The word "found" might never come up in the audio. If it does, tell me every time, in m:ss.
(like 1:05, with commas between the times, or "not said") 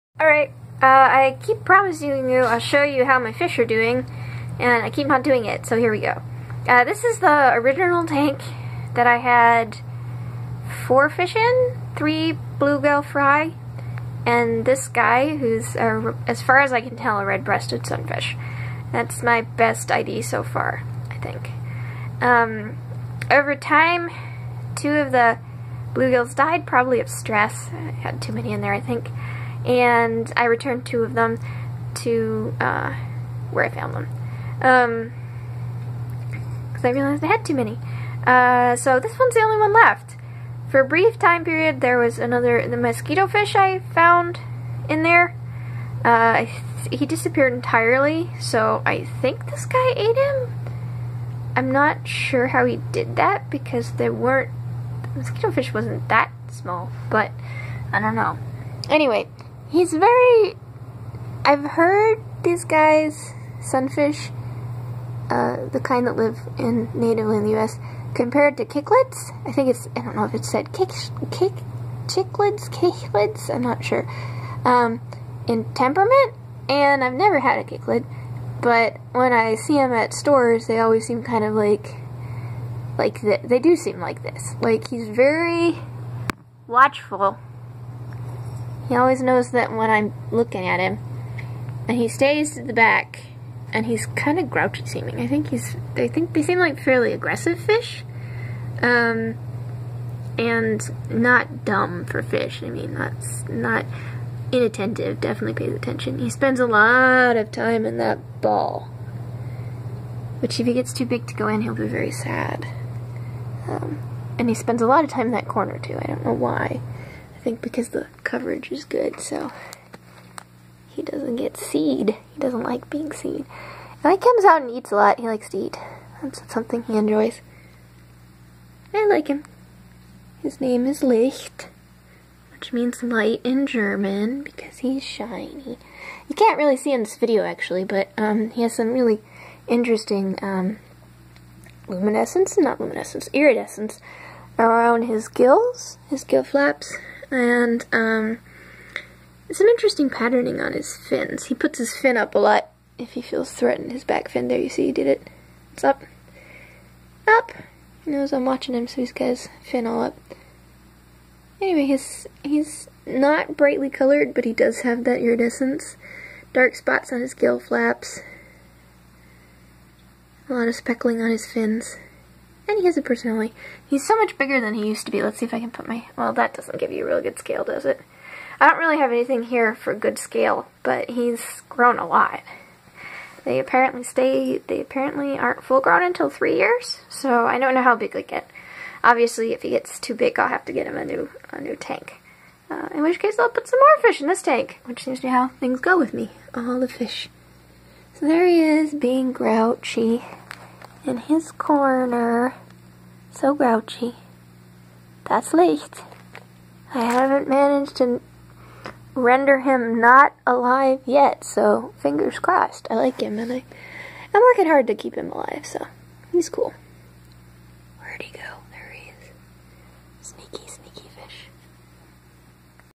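0:33, 0:43.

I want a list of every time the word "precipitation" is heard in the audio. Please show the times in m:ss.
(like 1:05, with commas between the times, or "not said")
not said.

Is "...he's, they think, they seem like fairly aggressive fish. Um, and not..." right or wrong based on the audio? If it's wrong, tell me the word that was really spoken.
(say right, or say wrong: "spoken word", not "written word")
right.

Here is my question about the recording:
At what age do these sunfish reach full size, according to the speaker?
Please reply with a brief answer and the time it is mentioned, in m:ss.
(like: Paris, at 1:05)
3 years, at 3:06.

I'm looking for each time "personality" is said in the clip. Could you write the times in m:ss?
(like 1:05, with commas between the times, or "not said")
2:53.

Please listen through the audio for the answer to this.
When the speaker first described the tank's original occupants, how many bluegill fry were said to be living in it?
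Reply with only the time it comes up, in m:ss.
0:11.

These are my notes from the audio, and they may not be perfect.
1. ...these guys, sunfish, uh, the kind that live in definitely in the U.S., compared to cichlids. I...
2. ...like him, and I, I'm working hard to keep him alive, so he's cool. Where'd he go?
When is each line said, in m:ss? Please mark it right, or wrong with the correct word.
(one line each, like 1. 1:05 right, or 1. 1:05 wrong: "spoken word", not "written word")
1. 1:02 wrong: "natively", not "definitely"
2. 3:32 right.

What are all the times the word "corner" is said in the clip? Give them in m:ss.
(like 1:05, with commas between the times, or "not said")
1:55, 3:21.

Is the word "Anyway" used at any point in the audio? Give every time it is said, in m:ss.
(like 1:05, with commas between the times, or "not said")
0:58, 2:41.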